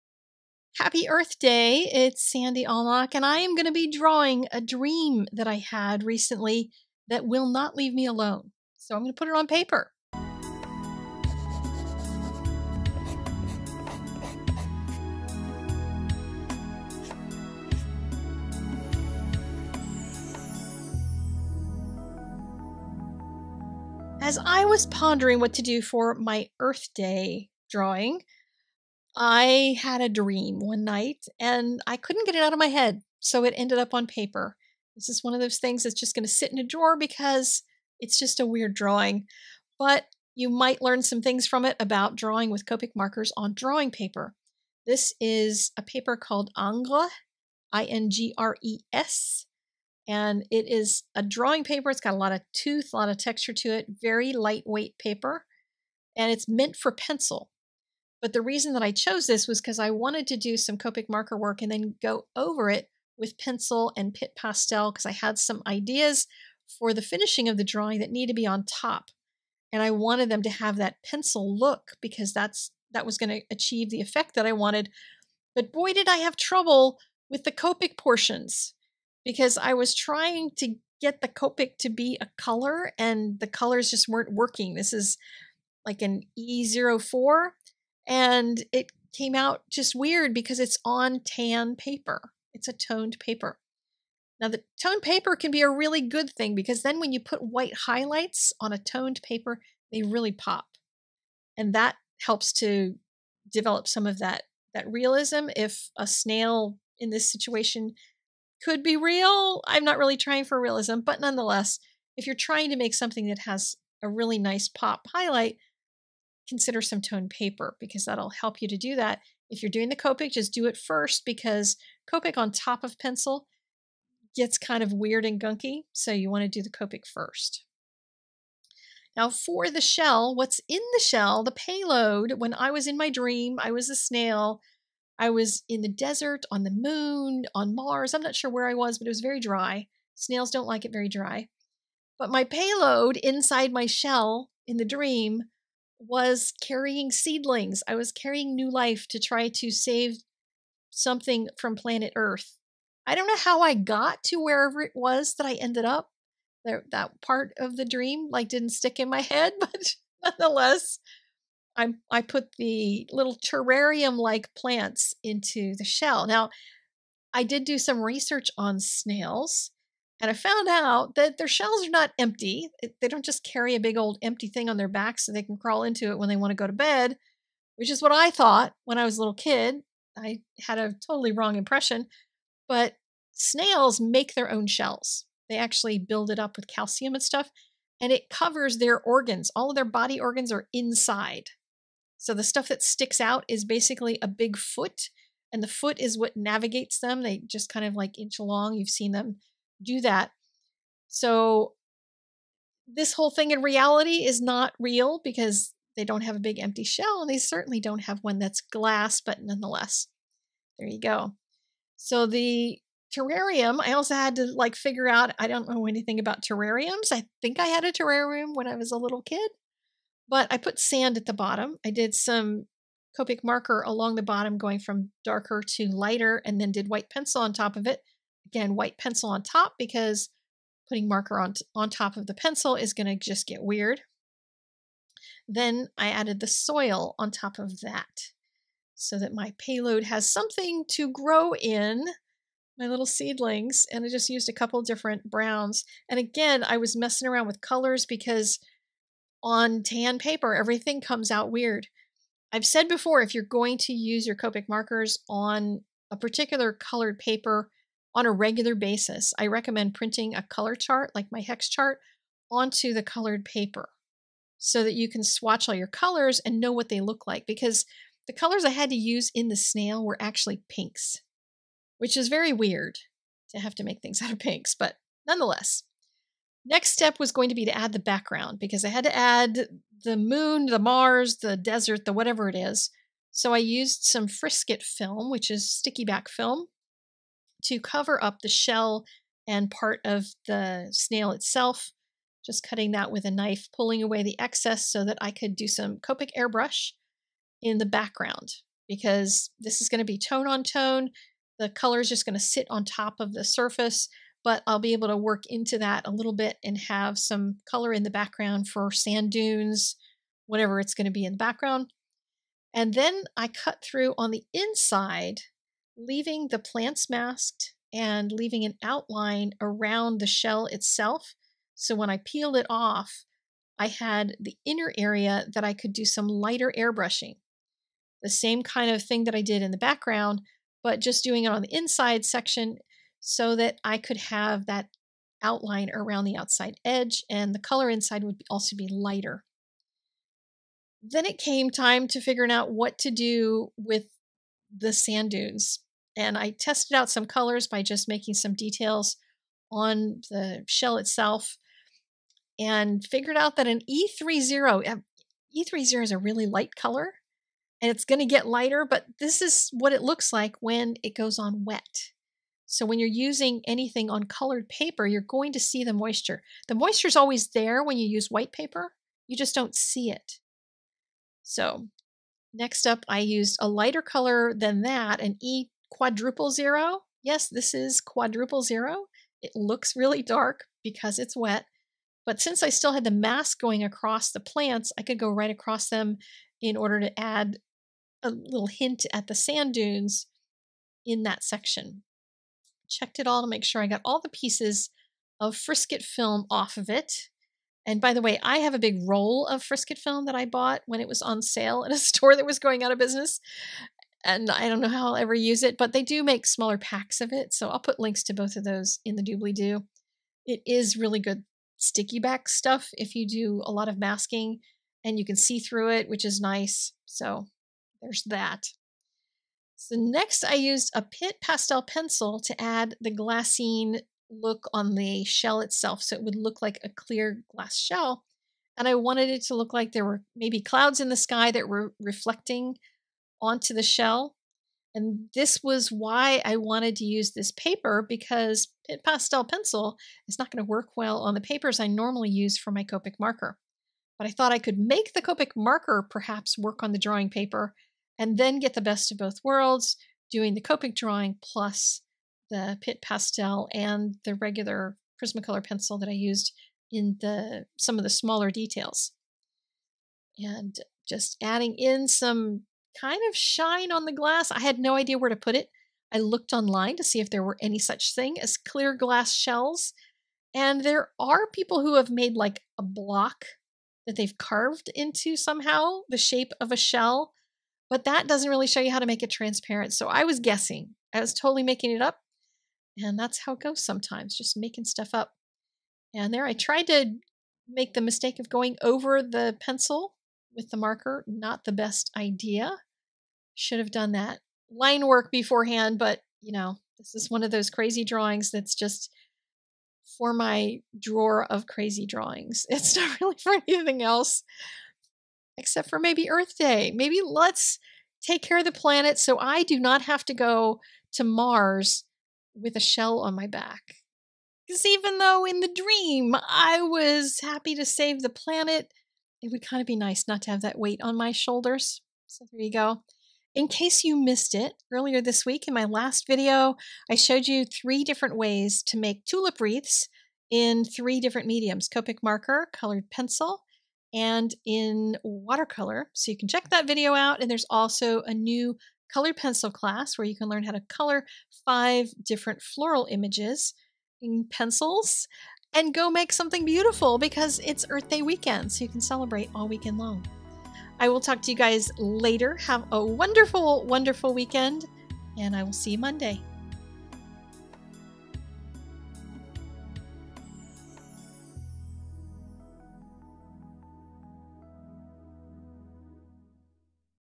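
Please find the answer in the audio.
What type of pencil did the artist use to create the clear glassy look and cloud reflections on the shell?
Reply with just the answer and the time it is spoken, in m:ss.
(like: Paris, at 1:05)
Pitt pastel pencil, at 7:01.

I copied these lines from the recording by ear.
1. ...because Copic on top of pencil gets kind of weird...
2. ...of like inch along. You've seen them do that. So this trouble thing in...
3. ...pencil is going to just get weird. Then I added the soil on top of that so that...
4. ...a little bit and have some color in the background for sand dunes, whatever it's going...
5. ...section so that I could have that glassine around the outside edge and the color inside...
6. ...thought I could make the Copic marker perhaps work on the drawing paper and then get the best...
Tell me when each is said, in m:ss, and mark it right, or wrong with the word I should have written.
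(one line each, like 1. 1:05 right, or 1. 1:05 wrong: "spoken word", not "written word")
1. 2:01 right
2. 3:17 wrong: "whole", not "trouble"
3. 3:52 right
4. 5:06 right
5. 5:32 wrong: "outline", not "glassine"
6. 7:24 right.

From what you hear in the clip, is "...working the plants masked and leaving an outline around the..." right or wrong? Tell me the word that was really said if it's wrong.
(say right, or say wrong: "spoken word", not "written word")
wrong: "leaving", not "working".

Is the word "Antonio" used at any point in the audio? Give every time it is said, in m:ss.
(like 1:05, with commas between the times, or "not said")
not said.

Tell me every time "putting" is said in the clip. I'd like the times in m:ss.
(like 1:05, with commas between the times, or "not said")
3:50.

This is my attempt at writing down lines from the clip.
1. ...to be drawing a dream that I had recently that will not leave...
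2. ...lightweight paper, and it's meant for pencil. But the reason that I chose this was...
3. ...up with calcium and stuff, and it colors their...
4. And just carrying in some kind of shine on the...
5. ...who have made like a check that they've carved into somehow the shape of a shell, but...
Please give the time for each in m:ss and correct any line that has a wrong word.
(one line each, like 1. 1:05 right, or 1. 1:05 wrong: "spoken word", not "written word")
1. 0:03 right
2. 0:54 right
3. 3:06 wrong: "covers", not "colors"
4. 7:40 wrong: "adding", not "carrying"
5. 7:51 wrong: "block", not "check".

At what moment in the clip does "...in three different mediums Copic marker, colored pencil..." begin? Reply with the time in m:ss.
8:50.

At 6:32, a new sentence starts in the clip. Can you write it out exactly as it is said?
Checked it all to make sure I got all the pieces of frisket film off of it.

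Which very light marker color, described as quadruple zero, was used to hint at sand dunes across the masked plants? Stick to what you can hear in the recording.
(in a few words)
E0000.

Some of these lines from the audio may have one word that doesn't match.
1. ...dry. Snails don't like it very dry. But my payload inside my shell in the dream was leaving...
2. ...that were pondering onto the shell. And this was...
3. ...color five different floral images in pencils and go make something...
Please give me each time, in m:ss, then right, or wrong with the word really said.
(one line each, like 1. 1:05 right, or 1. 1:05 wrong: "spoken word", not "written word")
1. 2:19 wrong: "carrying", not "leaving"
2. 7:11 wrong: "reflecting", not "pondering"
3. 9:00 right.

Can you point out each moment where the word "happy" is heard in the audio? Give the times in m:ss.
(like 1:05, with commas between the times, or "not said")
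0:00, 8:37.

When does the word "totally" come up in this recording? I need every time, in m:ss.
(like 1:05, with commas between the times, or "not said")
3:01, 8:01.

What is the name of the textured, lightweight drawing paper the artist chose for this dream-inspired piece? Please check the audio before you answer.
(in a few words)
Ingres.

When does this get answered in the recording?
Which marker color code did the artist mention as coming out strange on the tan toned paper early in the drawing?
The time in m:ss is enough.
1:26.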